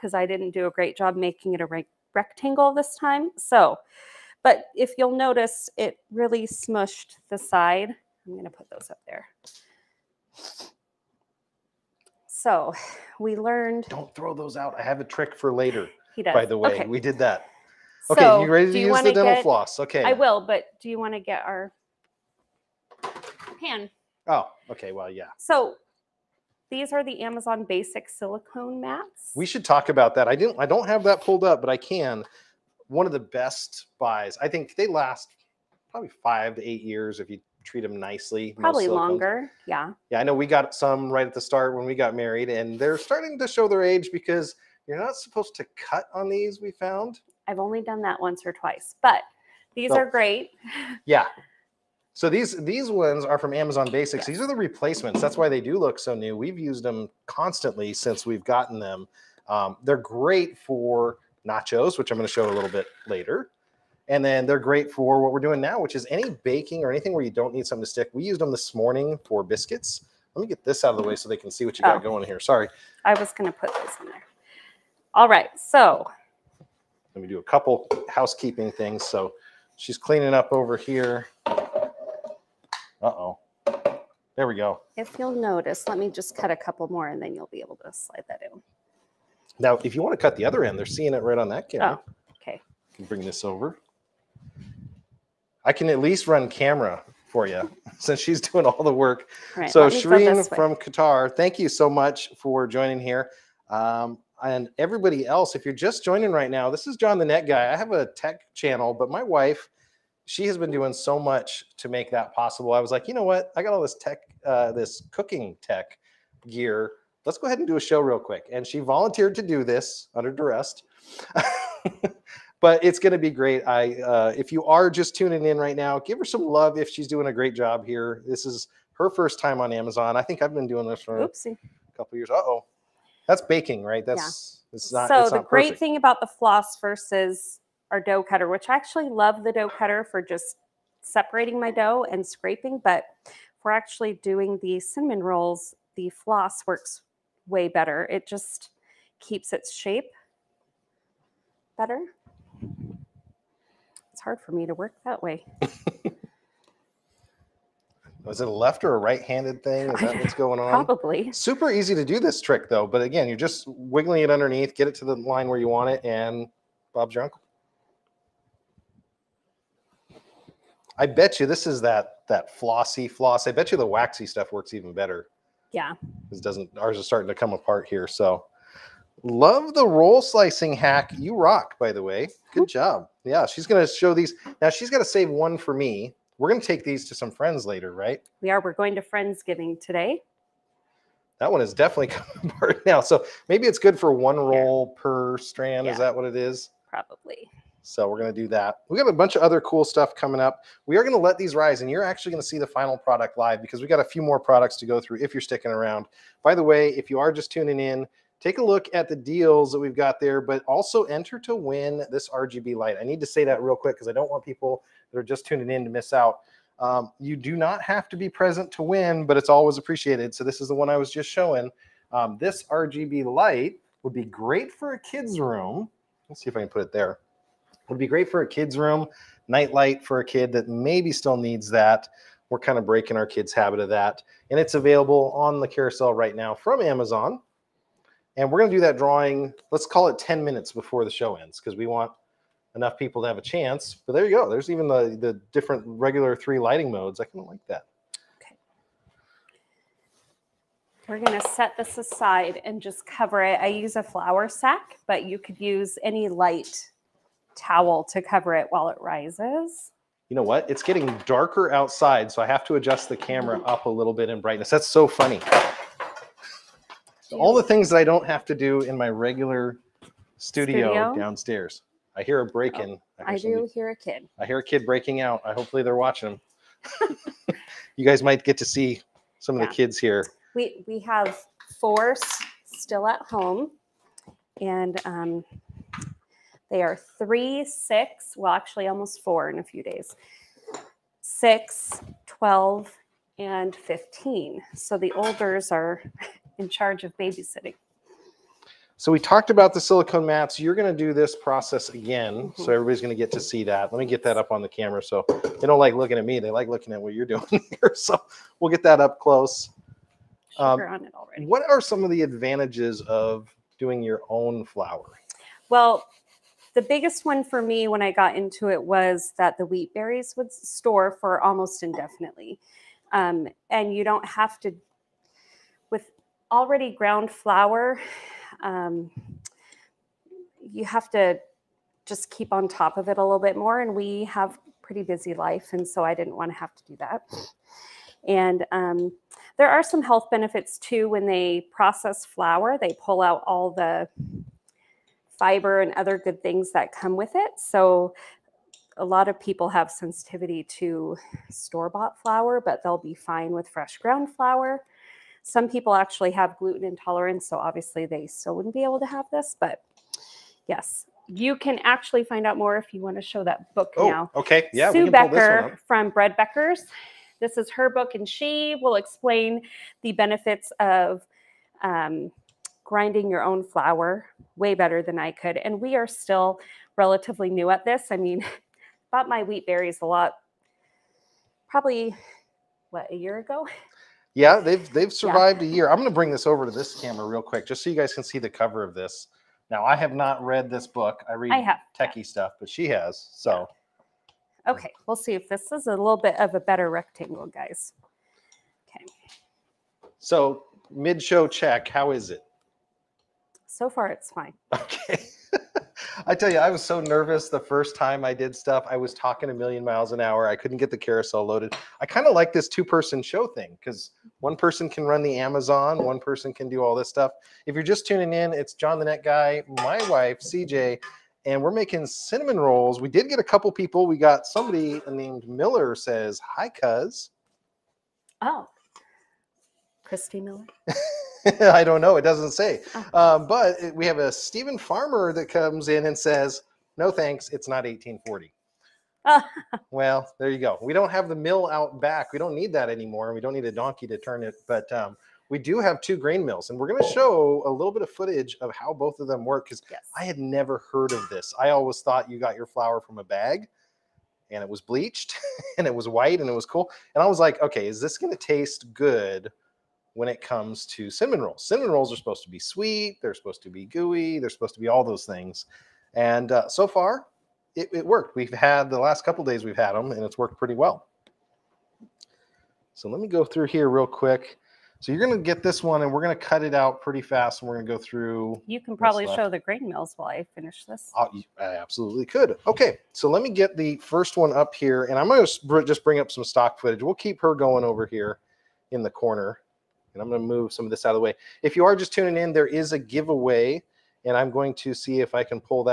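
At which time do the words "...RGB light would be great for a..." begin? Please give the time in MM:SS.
03:42.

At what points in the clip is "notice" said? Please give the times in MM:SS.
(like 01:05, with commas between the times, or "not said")
00:05, 01:25.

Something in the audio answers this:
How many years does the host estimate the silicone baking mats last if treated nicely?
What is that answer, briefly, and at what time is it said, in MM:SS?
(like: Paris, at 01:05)
5 to 8 years, at 00:36.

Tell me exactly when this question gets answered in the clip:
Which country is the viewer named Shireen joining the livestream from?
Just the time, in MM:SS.
01:40.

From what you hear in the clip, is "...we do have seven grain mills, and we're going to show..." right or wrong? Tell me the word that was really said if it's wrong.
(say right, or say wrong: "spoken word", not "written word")
wrong: "two", not "seven".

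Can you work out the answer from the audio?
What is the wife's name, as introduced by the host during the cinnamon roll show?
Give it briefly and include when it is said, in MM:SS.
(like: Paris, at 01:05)
CJ, at 07:00.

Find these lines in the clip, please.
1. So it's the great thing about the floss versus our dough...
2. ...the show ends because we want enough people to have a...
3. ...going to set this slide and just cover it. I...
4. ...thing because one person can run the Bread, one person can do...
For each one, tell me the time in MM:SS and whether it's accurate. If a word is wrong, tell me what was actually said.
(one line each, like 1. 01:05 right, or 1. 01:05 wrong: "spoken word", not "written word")
1. 02:15 right
2. 04:01 right
3. 04:11 wrong: "aside", not "slide"
4. 06:53 wrong: "Amazon", not "Bread".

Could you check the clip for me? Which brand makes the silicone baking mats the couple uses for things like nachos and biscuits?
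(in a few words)
Amazon Basics.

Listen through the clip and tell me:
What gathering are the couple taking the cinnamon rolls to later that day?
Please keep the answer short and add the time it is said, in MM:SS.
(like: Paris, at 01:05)
Friendsgiving, at 03:09.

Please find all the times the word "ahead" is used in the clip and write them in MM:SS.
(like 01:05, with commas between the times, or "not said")
01:57.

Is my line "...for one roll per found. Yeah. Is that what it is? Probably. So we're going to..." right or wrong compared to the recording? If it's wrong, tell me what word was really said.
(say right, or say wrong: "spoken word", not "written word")
wrong: "strand", not "found".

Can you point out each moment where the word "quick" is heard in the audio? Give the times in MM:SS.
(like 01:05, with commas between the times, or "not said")
01:58, 03:33, 06:27, 07:54.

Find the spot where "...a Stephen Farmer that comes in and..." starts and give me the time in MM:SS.
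07:14.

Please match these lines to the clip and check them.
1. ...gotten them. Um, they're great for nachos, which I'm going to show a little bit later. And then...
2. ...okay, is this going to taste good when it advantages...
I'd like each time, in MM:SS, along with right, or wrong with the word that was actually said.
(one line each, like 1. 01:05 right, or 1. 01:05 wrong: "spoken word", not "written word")
1. 00:58 right
2. 07:37 wrong: "comes", not "advantages".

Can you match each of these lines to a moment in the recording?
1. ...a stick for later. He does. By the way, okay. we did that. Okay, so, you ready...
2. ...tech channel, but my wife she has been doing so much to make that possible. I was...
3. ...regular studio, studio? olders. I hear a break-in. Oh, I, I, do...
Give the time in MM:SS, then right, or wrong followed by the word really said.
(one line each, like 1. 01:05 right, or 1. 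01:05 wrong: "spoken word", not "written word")
1. 00:14 wrong: "trick", not "stick"
2. 01:48 right
3. 04:29 wrong: "downstairs", not "olders".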